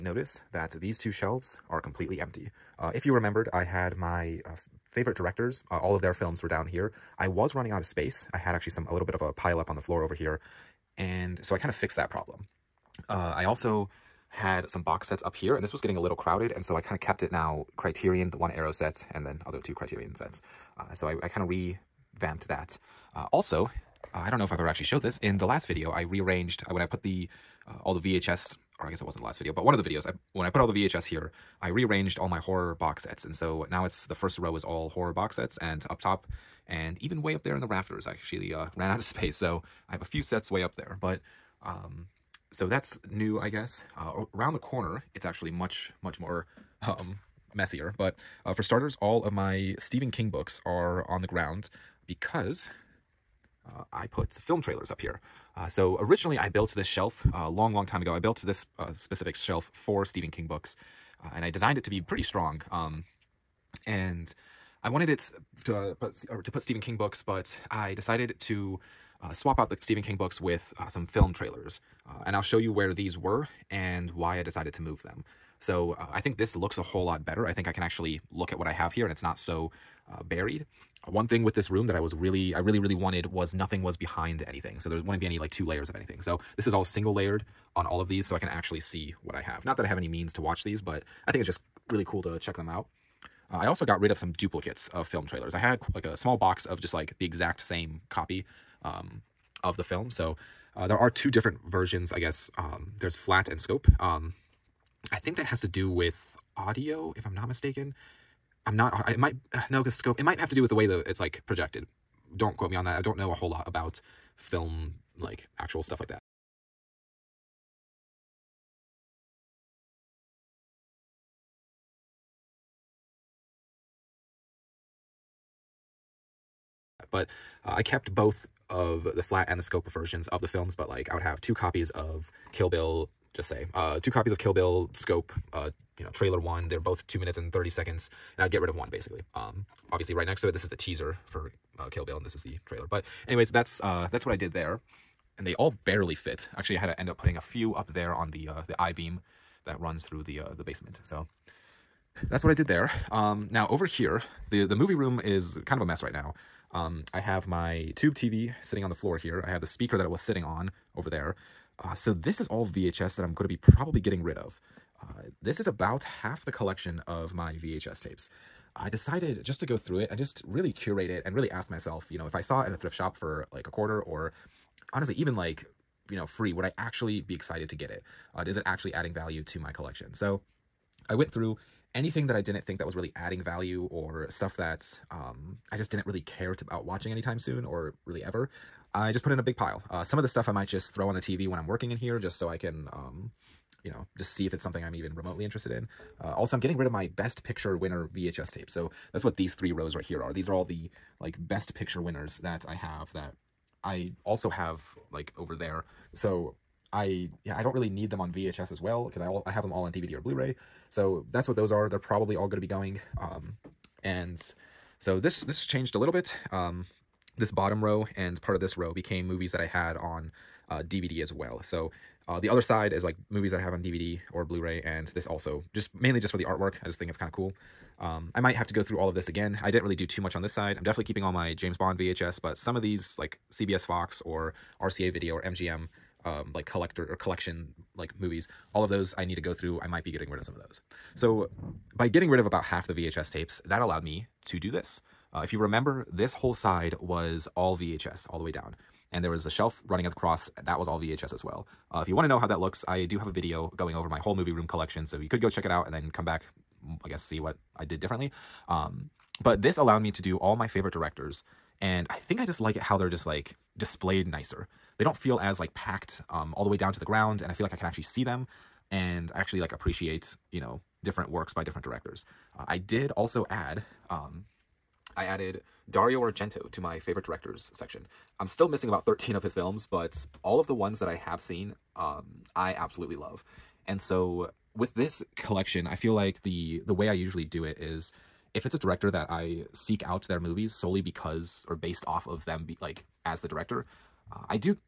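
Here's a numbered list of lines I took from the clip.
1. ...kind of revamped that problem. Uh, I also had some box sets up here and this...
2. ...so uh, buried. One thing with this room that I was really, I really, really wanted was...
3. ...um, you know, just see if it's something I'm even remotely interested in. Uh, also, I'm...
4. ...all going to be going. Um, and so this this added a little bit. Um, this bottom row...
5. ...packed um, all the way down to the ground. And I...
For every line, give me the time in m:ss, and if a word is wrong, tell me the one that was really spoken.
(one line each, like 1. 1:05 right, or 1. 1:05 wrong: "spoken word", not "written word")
1. 0:11 wrong: "fixed", not "revamped"
2. 1:19 right
3. 3:12 right
4. 3:32 wrong: "changed", not "added"
5. 4:25 right.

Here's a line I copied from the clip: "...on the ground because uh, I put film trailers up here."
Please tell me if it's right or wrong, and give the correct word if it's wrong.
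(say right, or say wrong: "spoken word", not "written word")
right.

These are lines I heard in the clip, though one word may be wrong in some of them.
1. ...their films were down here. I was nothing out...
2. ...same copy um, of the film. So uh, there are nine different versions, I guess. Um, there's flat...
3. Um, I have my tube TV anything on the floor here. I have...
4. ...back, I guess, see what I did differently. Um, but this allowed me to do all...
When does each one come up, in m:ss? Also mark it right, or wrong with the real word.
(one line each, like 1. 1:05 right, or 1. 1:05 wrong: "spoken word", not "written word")
1. 0:06 wrong: "running", not "nothing"
2. 1:37 wrong: "two", not "nine"
3. 2:36 wrong: "sitting", not "anything"
4. 4:16 right.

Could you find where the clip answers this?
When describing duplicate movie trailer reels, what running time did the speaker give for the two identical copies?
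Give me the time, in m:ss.
2:17.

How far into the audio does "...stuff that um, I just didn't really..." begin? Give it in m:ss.
3:04.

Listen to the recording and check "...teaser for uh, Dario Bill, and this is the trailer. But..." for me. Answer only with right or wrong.
wrong.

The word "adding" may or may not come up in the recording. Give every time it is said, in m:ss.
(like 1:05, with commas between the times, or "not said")
2:58, 3:03.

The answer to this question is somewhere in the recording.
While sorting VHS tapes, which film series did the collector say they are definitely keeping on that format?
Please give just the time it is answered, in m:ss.
3:51.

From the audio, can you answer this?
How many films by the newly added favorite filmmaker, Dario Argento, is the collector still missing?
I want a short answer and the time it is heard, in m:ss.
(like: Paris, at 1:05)
13, at 4:39.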